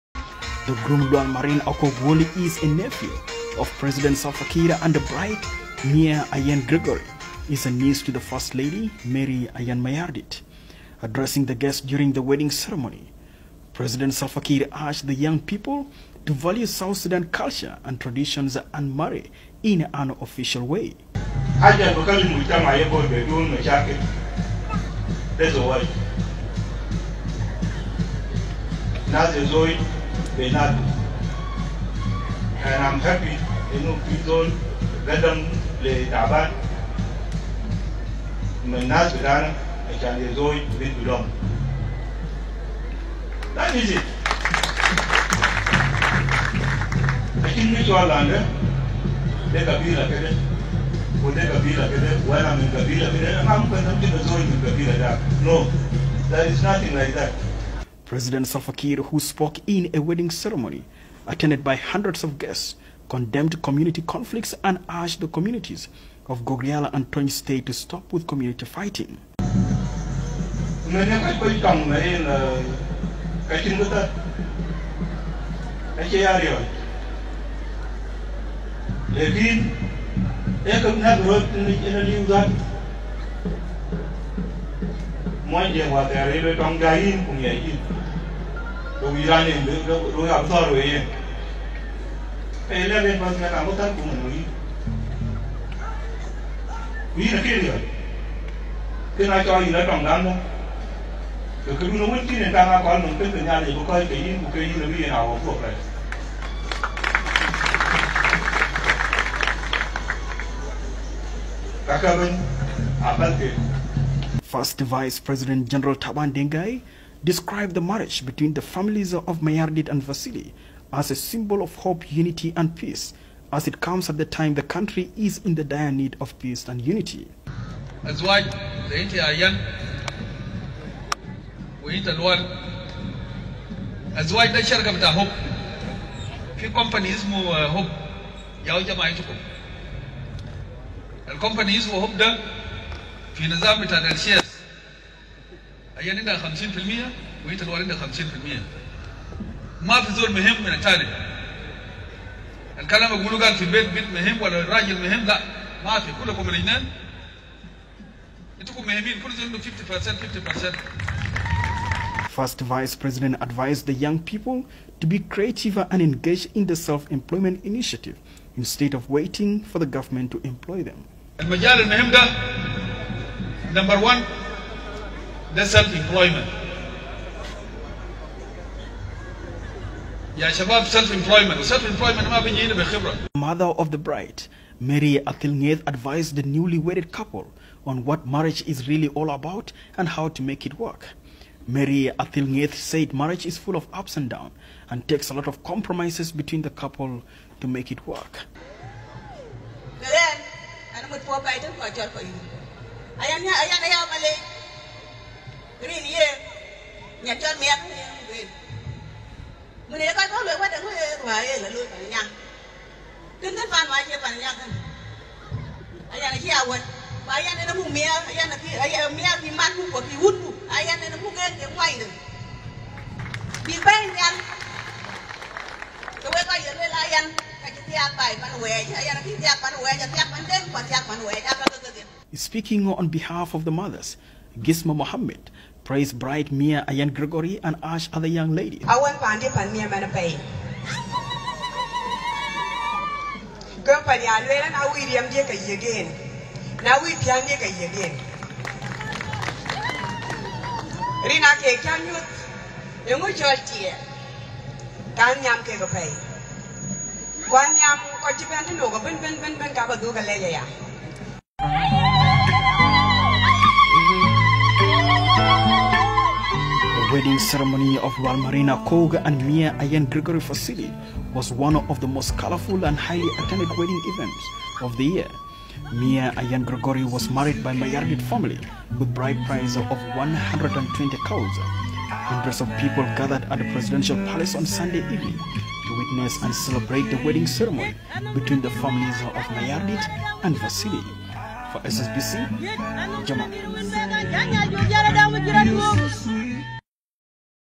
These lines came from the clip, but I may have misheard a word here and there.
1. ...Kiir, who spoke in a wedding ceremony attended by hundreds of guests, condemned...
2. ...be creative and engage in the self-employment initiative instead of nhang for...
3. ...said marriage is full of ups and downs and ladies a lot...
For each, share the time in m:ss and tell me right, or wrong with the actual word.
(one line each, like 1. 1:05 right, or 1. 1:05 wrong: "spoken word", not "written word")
1. 0:58 right
2. 2:45 wrong: "waiting", not "nhang"
3. 3:12 wrong: "takes", not "ladies".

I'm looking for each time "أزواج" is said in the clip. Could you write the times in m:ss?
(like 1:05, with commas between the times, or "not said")
2:08, 2:14.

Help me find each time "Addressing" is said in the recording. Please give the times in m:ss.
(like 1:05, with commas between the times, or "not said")
0:11.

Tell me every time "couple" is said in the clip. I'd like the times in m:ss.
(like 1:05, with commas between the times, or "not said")
3:07, 3:16.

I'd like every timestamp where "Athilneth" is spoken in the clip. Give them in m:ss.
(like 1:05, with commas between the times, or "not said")
3:05, 3:12.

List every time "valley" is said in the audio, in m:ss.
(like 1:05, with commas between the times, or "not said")
not said.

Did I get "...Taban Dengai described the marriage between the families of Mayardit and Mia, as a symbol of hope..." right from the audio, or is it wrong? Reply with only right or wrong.
wrong.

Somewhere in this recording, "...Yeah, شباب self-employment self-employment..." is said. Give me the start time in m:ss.
3:00.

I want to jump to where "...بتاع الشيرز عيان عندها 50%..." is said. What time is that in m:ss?
2:23.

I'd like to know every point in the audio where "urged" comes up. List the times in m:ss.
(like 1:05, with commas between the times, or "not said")
0:14, 1:04, 3:57.